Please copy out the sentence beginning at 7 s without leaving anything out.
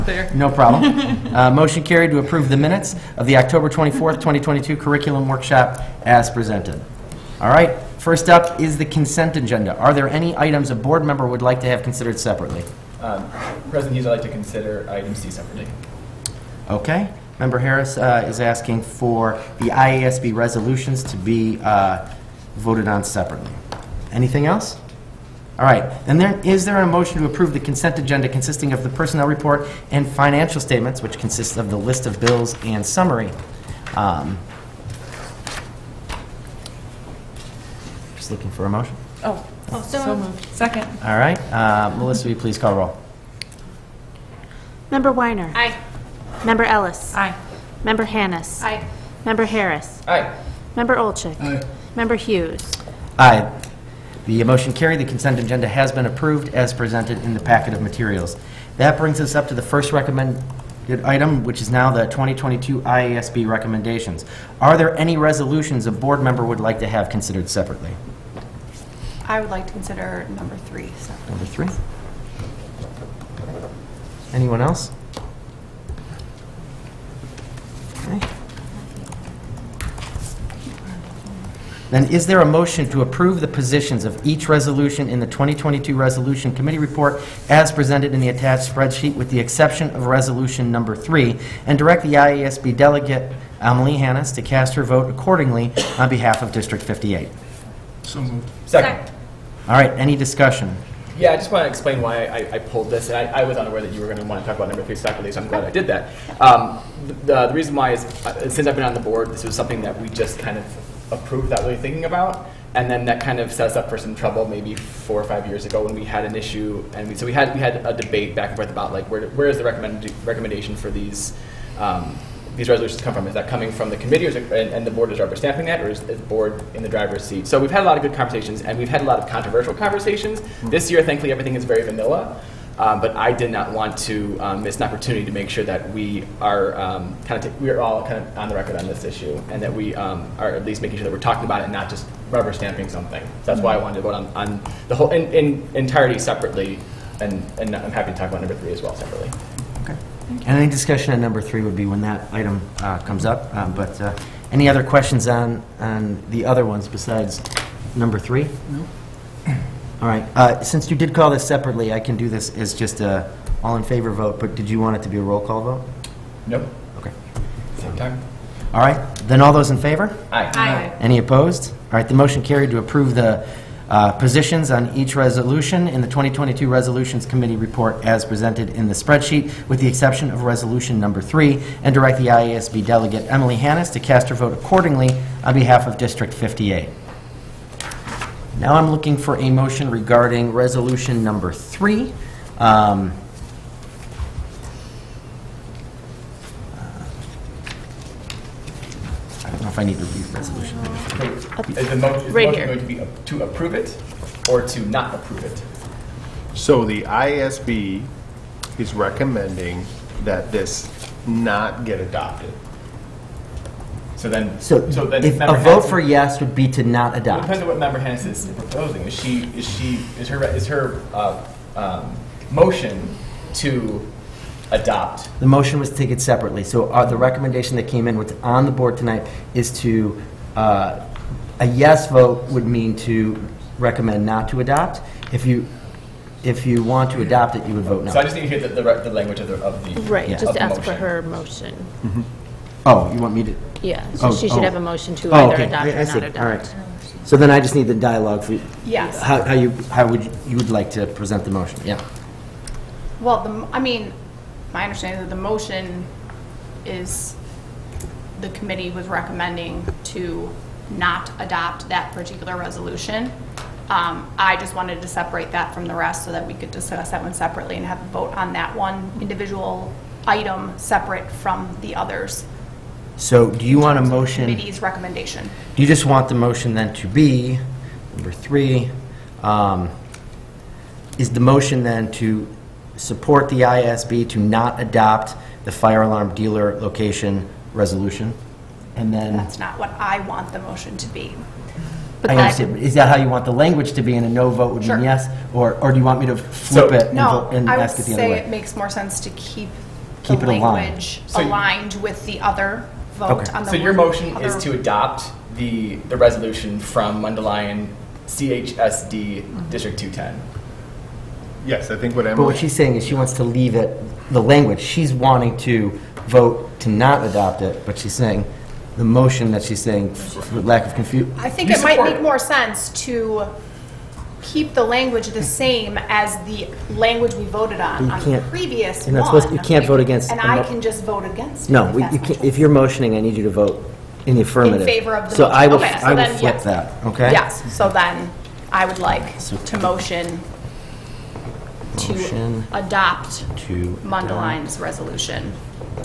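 All right, first up is the consent agenda.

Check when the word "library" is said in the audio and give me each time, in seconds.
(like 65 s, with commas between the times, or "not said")
not said.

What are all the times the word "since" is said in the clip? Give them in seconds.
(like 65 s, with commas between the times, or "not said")
108 s, 160 s.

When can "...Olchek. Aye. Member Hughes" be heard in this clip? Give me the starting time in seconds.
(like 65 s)
50 s.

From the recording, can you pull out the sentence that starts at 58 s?
That brings us up to the first recommended item, which is now the 2022 IASB recommendations.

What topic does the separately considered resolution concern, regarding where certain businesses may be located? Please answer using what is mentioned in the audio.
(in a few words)
firearm dealer location.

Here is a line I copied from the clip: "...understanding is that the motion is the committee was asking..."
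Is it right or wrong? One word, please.
wrong.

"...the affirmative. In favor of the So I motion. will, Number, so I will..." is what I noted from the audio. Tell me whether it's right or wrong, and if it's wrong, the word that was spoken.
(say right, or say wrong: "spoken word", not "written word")
wrong: "Okay", not "Number".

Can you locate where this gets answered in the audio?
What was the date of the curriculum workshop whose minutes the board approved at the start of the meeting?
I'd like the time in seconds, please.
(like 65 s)
3 s.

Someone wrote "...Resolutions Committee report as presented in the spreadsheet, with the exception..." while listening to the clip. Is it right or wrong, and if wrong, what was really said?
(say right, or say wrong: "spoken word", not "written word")
right.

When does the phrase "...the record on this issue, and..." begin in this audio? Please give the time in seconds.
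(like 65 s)
138 s.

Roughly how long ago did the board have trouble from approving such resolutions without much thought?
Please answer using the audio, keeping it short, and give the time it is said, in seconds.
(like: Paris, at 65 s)
four or five years, at 114 s.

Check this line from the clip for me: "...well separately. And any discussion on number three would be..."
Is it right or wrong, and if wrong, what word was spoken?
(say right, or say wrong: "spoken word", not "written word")
right.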